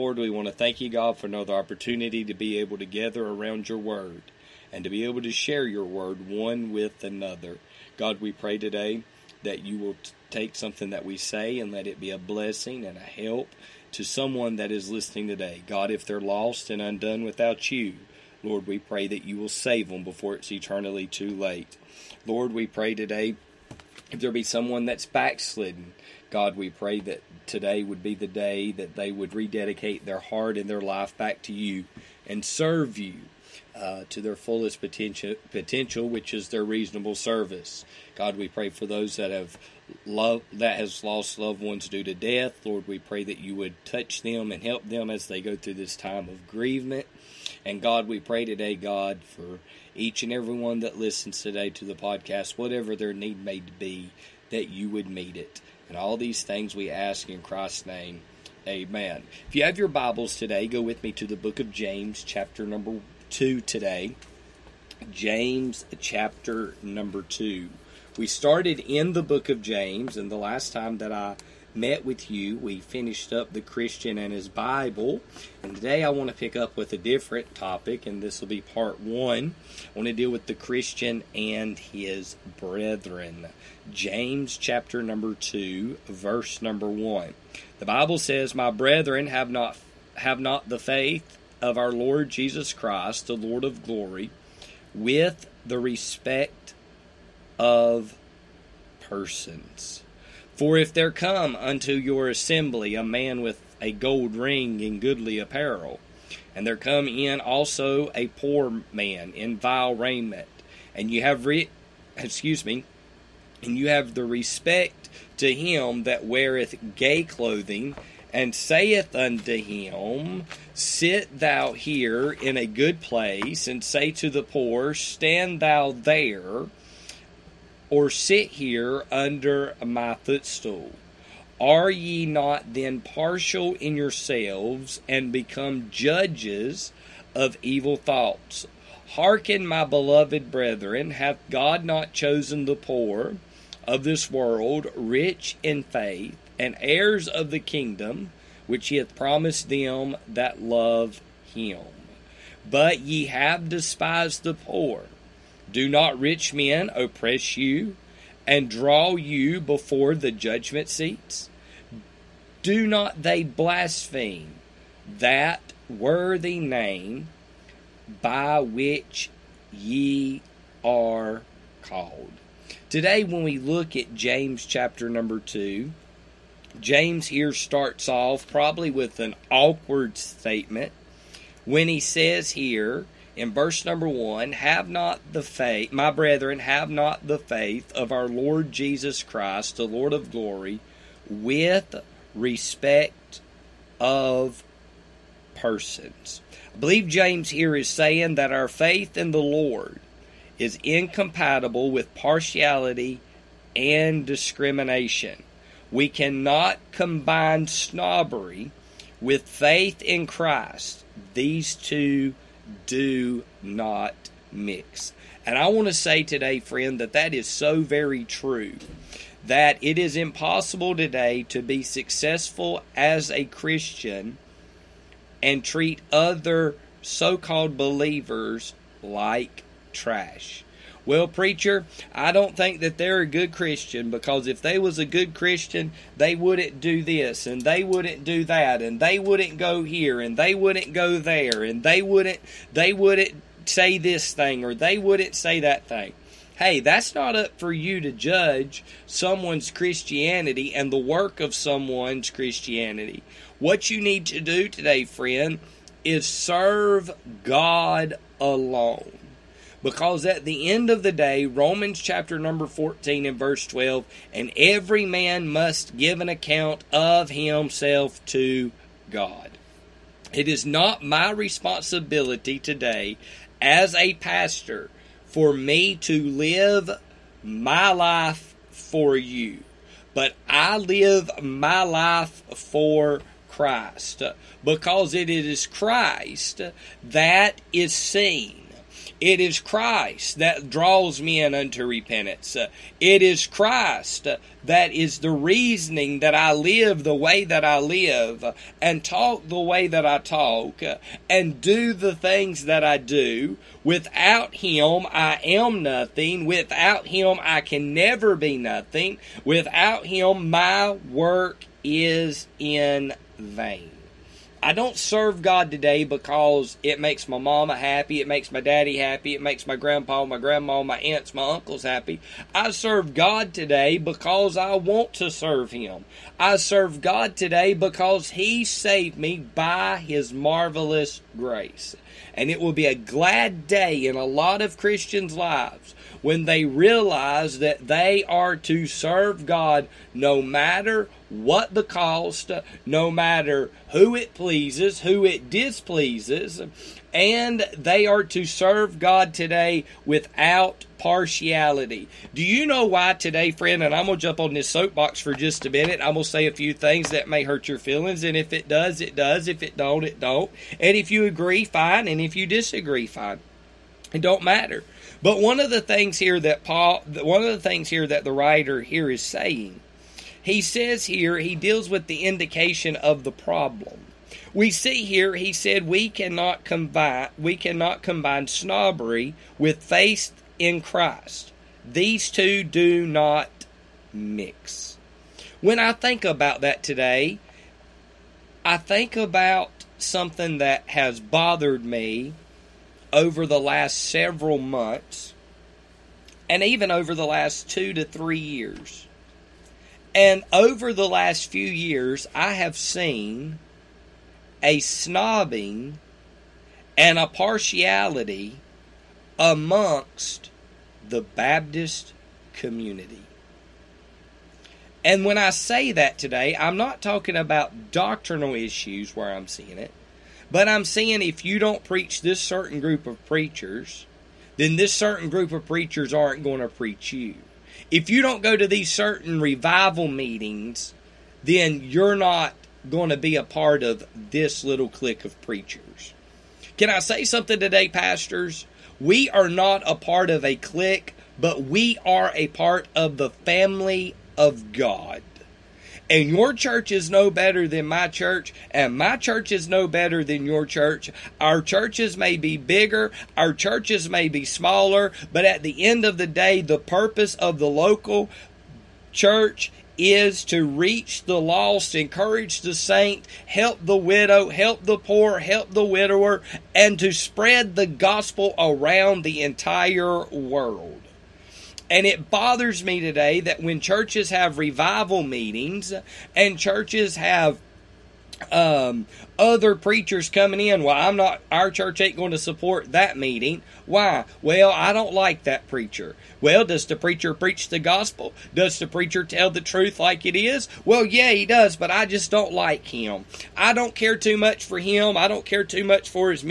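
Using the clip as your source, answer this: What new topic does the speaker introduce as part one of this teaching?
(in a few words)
The Christian and his brethren.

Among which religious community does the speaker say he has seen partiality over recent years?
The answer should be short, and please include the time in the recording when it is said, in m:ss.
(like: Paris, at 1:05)
Baptist community, at 6:51.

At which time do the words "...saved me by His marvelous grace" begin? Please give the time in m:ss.
5:28.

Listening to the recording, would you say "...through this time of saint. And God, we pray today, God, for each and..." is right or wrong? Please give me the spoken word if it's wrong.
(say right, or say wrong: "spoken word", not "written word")
wrong: "grievement", not "saint".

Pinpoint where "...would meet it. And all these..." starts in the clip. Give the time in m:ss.
0:54.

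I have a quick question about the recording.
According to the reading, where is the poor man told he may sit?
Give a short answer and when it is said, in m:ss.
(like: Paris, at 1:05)
Under my footstool, at 2:09.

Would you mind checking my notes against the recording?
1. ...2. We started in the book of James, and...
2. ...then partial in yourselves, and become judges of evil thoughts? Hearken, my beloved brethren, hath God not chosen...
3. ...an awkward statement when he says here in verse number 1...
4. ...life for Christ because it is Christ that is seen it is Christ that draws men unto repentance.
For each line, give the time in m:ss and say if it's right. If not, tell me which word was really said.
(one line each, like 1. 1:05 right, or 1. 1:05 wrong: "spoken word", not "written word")
1. 1:07 right
2. 2:12 right
3. 2:59 right
4. 4:41 right.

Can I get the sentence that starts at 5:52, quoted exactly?
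Do you know why today, friend?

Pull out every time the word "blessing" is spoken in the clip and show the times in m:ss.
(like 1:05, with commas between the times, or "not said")
0:12.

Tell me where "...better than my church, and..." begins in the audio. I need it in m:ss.
7:27.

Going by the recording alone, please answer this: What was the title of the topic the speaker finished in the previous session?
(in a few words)
The Christian and His Bible.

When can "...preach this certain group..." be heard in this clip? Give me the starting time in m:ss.
7:01.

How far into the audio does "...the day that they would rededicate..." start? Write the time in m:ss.
0:28.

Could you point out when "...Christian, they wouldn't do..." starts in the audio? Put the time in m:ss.
3:55.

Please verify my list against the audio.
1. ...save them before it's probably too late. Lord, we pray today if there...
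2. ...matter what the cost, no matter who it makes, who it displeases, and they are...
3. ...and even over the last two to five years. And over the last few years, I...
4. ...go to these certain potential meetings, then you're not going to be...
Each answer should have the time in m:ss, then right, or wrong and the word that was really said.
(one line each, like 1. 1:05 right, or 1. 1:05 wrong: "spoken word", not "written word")
1. 0:19 wrong: "eternally", not "probably"
2. 5:40 wrong: "pleases", not "makes"
3. 6:36 wrong: "three", not "five"
4. 7:08 wrong: "revival", not "potential".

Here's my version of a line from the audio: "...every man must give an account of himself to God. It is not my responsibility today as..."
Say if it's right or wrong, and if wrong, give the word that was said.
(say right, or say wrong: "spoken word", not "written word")
right.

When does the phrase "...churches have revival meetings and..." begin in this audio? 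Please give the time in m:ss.
7:53.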